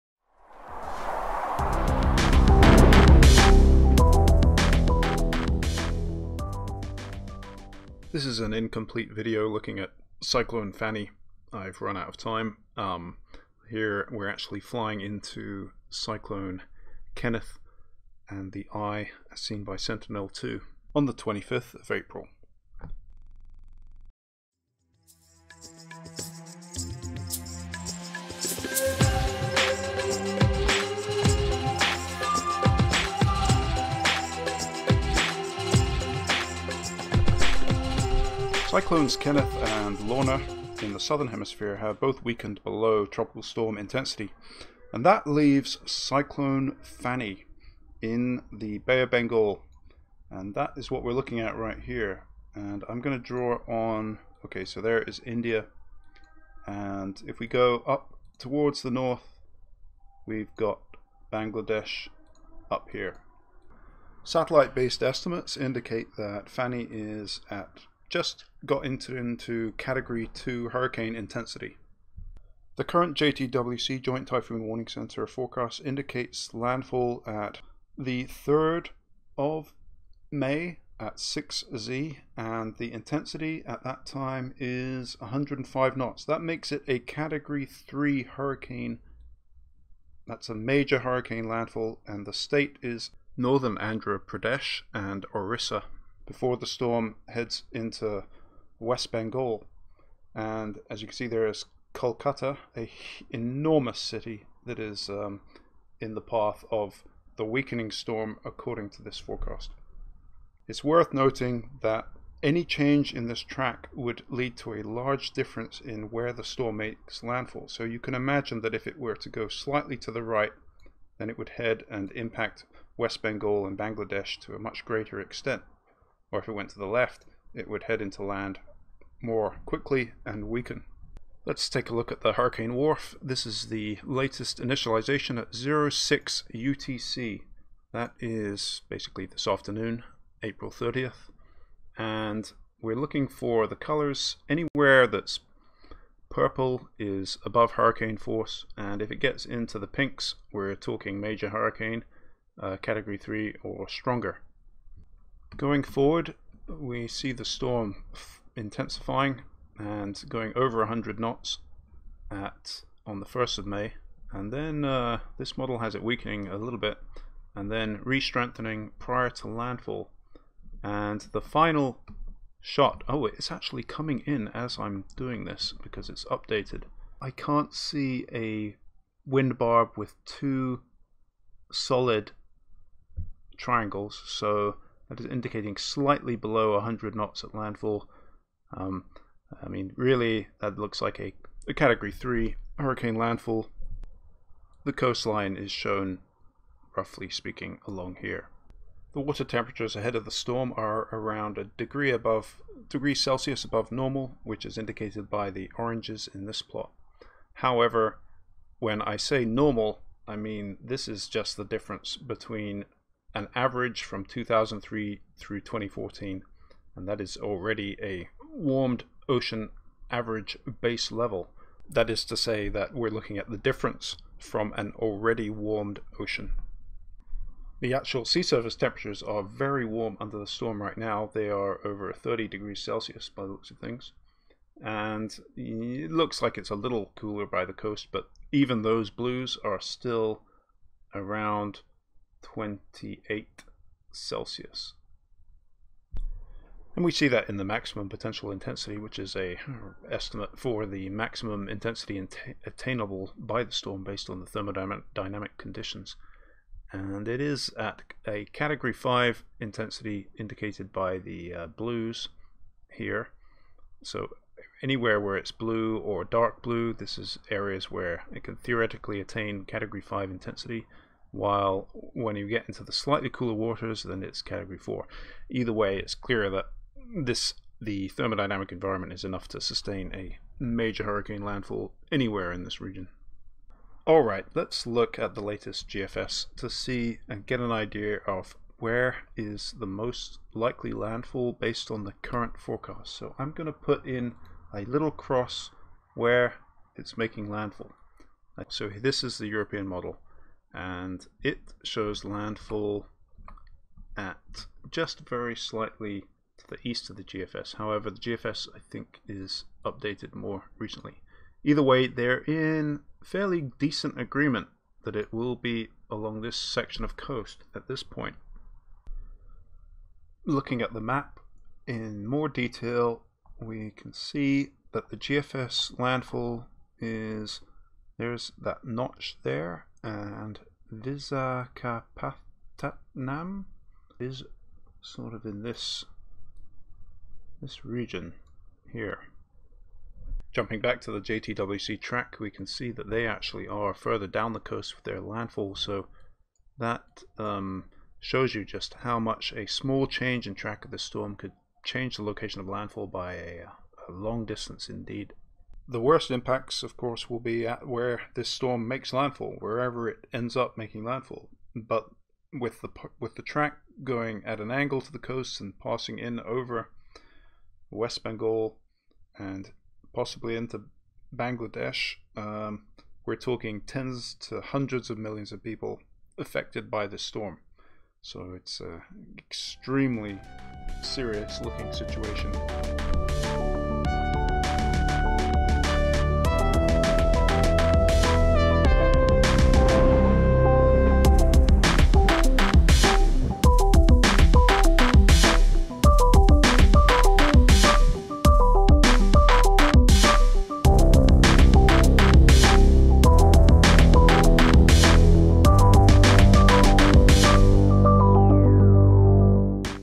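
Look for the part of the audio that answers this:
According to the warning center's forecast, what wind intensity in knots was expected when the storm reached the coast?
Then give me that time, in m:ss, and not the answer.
1:25.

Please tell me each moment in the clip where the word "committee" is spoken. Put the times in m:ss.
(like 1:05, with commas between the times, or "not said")
not said.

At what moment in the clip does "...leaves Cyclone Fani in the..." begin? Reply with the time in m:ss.
0:45.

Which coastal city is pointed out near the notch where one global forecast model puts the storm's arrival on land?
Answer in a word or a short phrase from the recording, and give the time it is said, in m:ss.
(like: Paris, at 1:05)
Visakhapatnam, at 5:30.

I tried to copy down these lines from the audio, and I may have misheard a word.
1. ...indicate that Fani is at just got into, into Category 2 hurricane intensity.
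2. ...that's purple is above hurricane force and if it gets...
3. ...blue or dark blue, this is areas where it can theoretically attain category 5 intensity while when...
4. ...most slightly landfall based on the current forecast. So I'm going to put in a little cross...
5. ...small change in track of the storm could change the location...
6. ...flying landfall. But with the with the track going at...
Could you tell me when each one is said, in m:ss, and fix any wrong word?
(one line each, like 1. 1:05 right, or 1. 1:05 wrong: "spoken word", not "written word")
1. 1:05 right
2. 2:25 right
3. 4:25 right
4. 4:49 wrong: "likely", not "slightly"
5. 5:49 right
6. 6:00 wrong: "making", not "flying".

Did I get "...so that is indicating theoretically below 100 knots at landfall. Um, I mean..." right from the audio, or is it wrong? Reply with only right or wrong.
wrong.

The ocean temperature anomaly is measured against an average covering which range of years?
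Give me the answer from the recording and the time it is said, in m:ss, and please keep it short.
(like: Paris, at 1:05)
2003 through 2014, at 3:34.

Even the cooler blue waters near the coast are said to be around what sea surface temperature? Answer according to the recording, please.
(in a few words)
28 Celsius.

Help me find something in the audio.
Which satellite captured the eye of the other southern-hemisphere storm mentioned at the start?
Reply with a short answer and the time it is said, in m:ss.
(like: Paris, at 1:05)
Sentinel-2, at 0:19.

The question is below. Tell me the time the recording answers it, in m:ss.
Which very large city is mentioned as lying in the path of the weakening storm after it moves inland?
1:41.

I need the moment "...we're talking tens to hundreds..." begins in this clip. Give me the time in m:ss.
6:13.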